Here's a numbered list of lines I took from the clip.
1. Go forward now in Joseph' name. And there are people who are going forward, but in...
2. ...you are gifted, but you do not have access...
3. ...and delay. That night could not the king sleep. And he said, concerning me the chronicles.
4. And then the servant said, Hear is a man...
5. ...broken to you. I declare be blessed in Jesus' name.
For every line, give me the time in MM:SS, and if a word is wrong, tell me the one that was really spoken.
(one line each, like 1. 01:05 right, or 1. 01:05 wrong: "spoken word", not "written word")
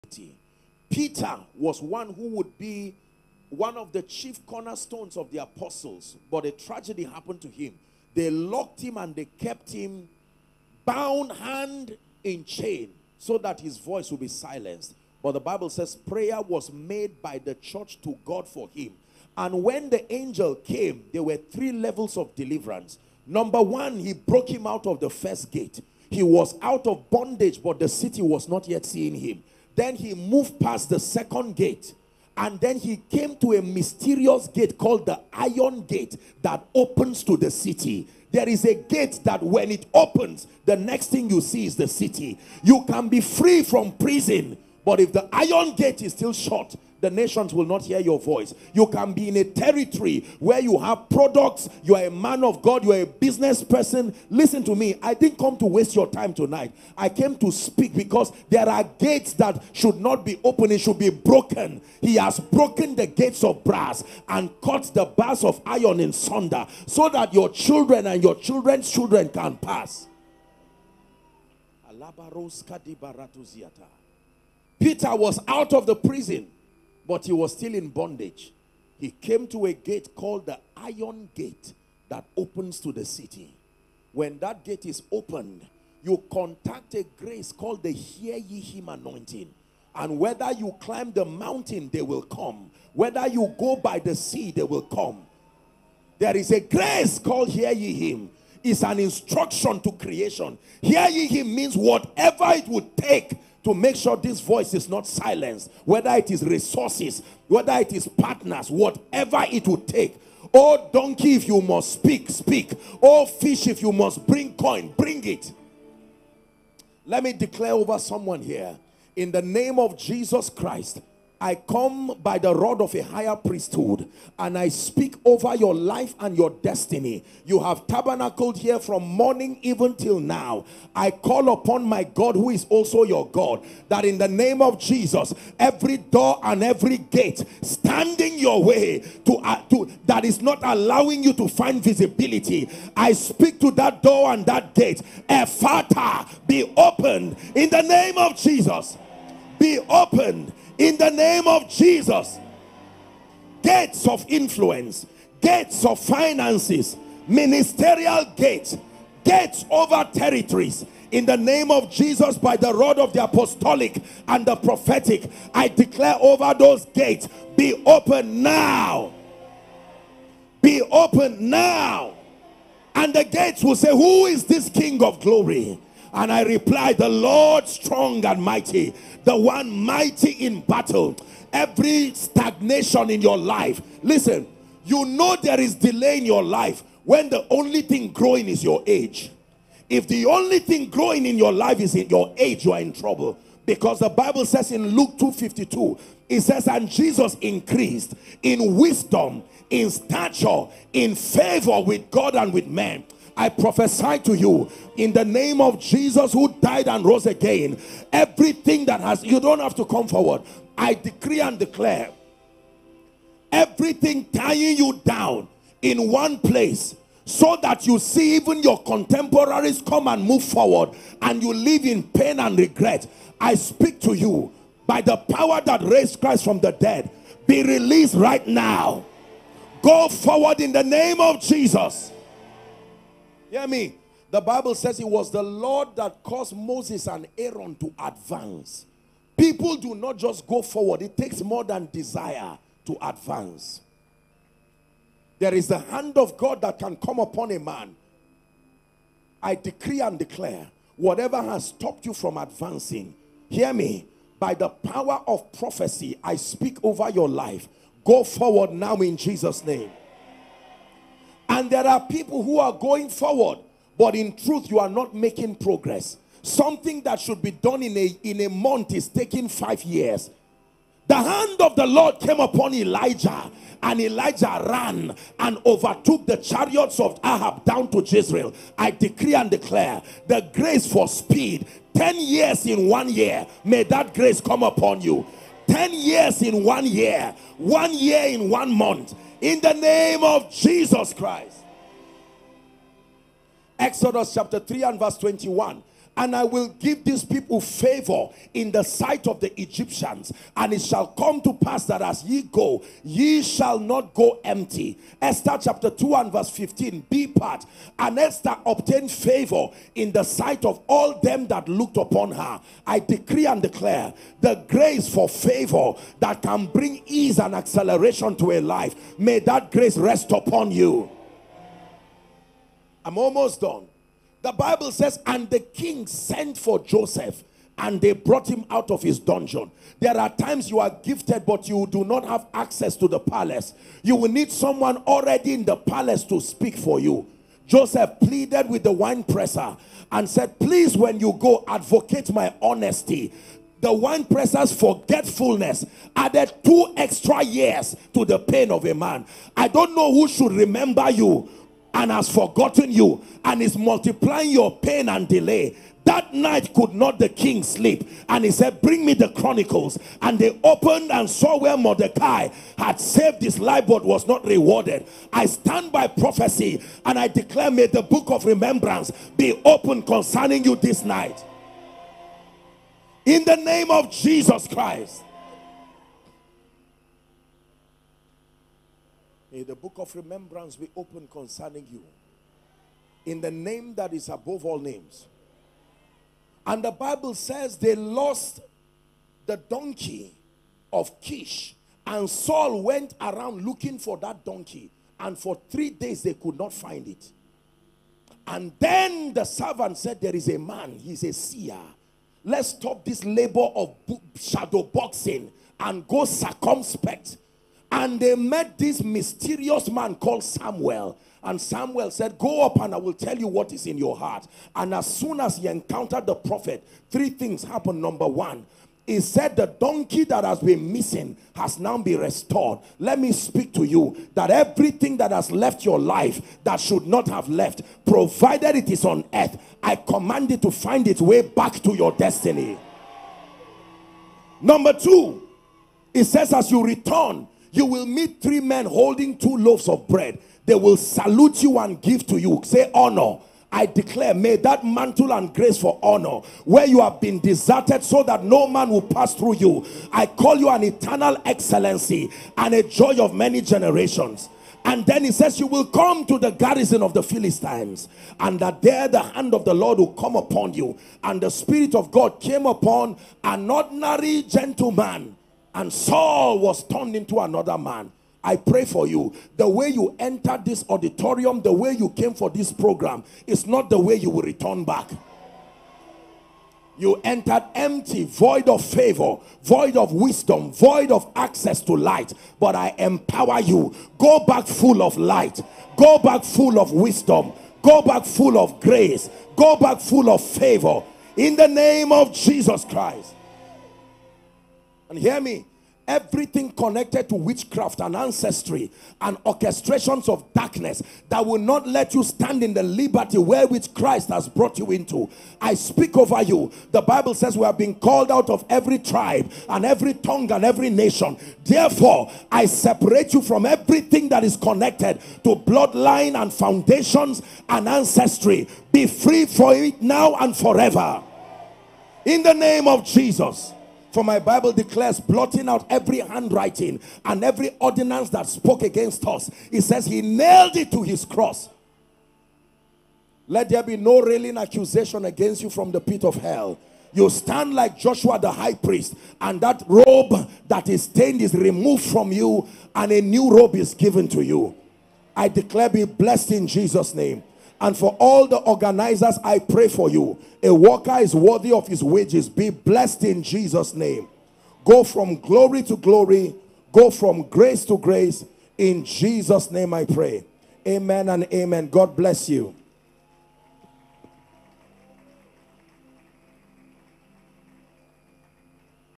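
1. 04:18 wrong: "Jesus", not "Joseph"
2. 05:30 right
3. 05:55 wrong: "bring", not "concerning"
4. 06:38 wrong: "There", not "Hear"
5. 09:03 wrong: "given", not "broken".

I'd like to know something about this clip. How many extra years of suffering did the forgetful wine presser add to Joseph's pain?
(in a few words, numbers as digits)
2.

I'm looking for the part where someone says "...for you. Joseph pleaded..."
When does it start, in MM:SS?
05:36.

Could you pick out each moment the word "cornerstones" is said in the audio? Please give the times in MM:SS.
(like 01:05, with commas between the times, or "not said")
00:04.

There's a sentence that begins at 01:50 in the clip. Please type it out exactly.
Oh, donkey, if you must speak, speak.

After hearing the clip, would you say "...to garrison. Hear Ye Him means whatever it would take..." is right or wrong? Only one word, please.
wrong.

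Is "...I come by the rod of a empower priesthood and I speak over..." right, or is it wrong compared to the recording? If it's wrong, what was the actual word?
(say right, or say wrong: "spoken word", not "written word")
wrong: "higher", not "empower".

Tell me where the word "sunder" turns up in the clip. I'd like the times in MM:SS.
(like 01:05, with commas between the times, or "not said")
01:06.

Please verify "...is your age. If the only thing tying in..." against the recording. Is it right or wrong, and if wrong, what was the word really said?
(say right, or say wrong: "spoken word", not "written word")
wrong: "growing", not "tying".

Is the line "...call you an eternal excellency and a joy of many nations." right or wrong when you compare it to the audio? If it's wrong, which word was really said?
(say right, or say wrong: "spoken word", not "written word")
wrong: "generations", not "nations".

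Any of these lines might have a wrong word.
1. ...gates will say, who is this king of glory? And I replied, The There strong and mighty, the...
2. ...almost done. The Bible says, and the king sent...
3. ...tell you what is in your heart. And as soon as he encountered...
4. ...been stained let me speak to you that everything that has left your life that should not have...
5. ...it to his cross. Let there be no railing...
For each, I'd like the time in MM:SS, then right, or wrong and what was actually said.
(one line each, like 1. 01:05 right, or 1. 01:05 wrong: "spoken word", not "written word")
1. 02:53 wrong: "Lord", not "There"
2. 05:23 right
3. 06:53 right
4. 07:01 wrong: "restored", not "stained"
5. 08:50 right.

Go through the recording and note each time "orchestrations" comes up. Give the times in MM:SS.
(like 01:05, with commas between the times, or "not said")
08:19.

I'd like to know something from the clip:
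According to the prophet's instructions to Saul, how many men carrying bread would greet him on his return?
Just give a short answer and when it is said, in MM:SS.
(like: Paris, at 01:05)
3, at 07:18.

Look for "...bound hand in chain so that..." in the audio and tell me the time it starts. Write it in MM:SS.
00:10.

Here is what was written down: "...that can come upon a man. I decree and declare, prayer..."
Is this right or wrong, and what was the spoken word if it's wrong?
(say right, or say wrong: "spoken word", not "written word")
wrong: "whatever", not "prayer".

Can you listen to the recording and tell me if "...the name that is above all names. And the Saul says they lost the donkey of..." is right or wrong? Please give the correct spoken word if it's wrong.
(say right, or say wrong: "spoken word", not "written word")
wrong: "Bible", not "Saul".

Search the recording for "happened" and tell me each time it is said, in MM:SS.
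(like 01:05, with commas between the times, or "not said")
00:07, 06:57.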